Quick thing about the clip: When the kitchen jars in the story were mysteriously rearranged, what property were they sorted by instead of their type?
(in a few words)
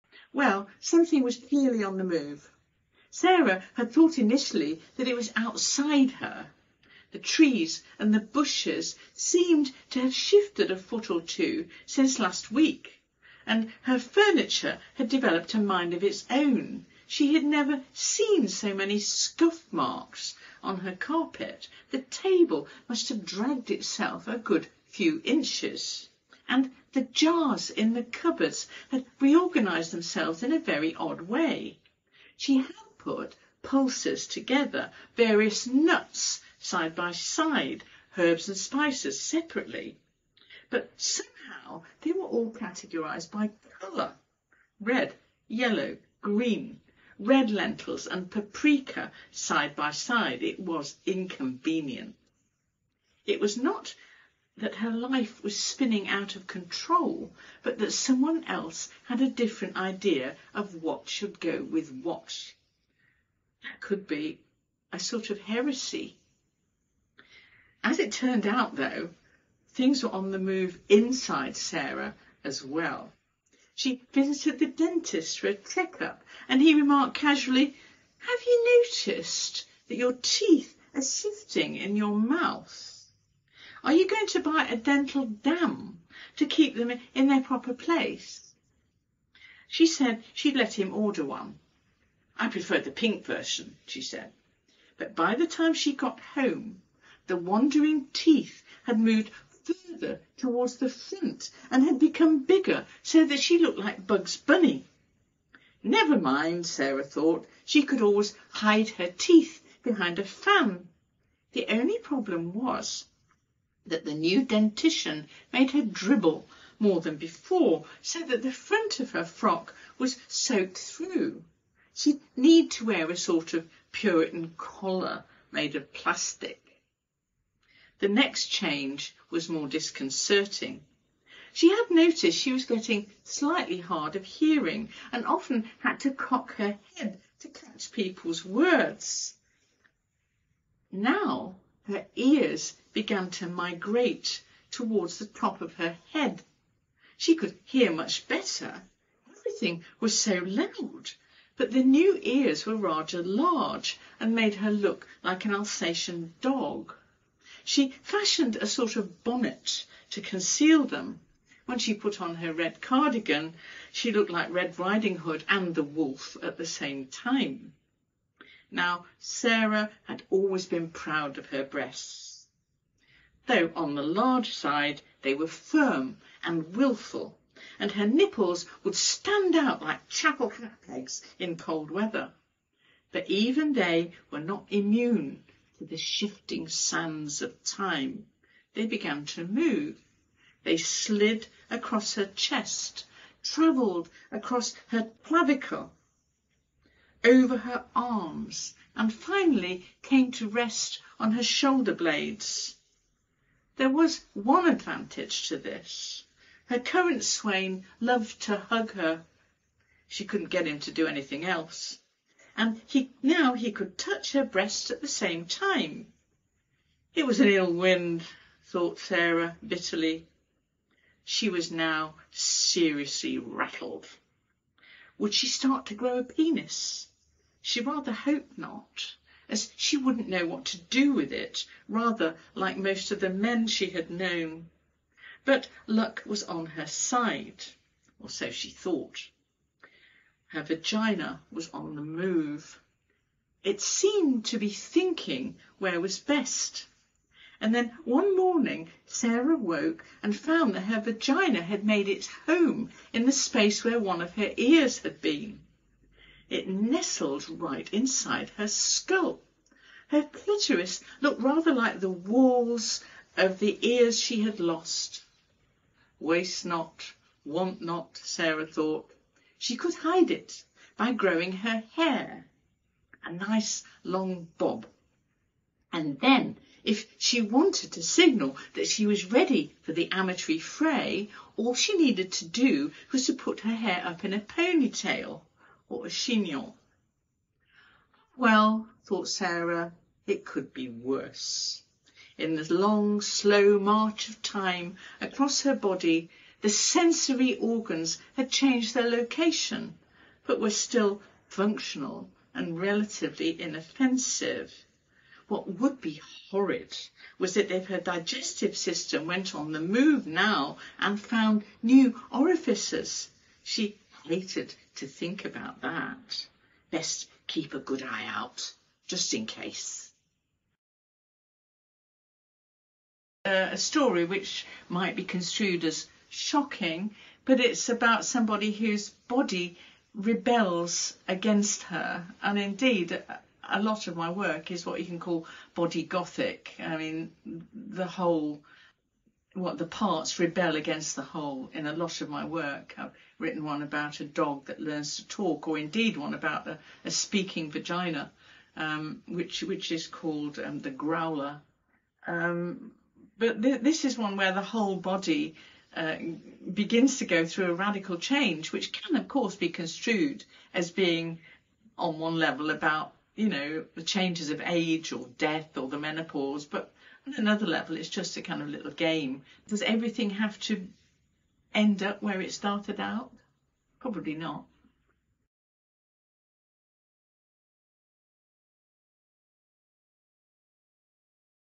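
colour.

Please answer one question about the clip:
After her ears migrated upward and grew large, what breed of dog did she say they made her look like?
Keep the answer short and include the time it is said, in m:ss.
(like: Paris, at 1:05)
Alsatian, at 2:35.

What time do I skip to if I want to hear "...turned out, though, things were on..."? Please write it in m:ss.
1:08.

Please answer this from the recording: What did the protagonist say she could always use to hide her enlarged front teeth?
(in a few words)
a fan.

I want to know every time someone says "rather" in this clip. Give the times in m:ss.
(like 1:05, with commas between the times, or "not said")
2:32, 3:47, 3:51, 4:21.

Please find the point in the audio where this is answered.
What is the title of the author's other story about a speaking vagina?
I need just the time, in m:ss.
5:50.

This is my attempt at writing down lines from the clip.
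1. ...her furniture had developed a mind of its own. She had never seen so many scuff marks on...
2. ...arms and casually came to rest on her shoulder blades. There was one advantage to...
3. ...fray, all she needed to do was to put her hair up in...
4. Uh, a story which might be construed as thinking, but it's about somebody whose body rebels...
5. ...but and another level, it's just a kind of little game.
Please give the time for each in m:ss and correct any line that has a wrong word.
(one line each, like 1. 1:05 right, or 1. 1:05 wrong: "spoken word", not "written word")
1. 0:13 right
2. 3:17 wrong: "finally", not "casually"
3. 4:40 right
4. 5:23 wrong: "shocking", not "thinking"
5. 6:06 right.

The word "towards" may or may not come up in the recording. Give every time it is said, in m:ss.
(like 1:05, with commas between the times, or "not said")
1:40, 2:24.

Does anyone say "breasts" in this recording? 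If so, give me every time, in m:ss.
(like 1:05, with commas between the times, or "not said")
2:51, 3:34.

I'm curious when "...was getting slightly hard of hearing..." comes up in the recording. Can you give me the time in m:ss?
2:12.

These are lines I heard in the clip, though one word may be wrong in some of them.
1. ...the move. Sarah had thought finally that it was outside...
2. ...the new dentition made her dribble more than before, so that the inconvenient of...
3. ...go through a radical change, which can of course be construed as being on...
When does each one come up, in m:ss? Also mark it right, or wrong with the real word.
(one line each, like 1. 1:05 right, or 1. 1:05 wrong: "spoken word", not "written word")
1. 0:01 wrong: "initially", not "finally"
2. 1:54 wrong: "front", not "inconvenient"
3. 5:57 right.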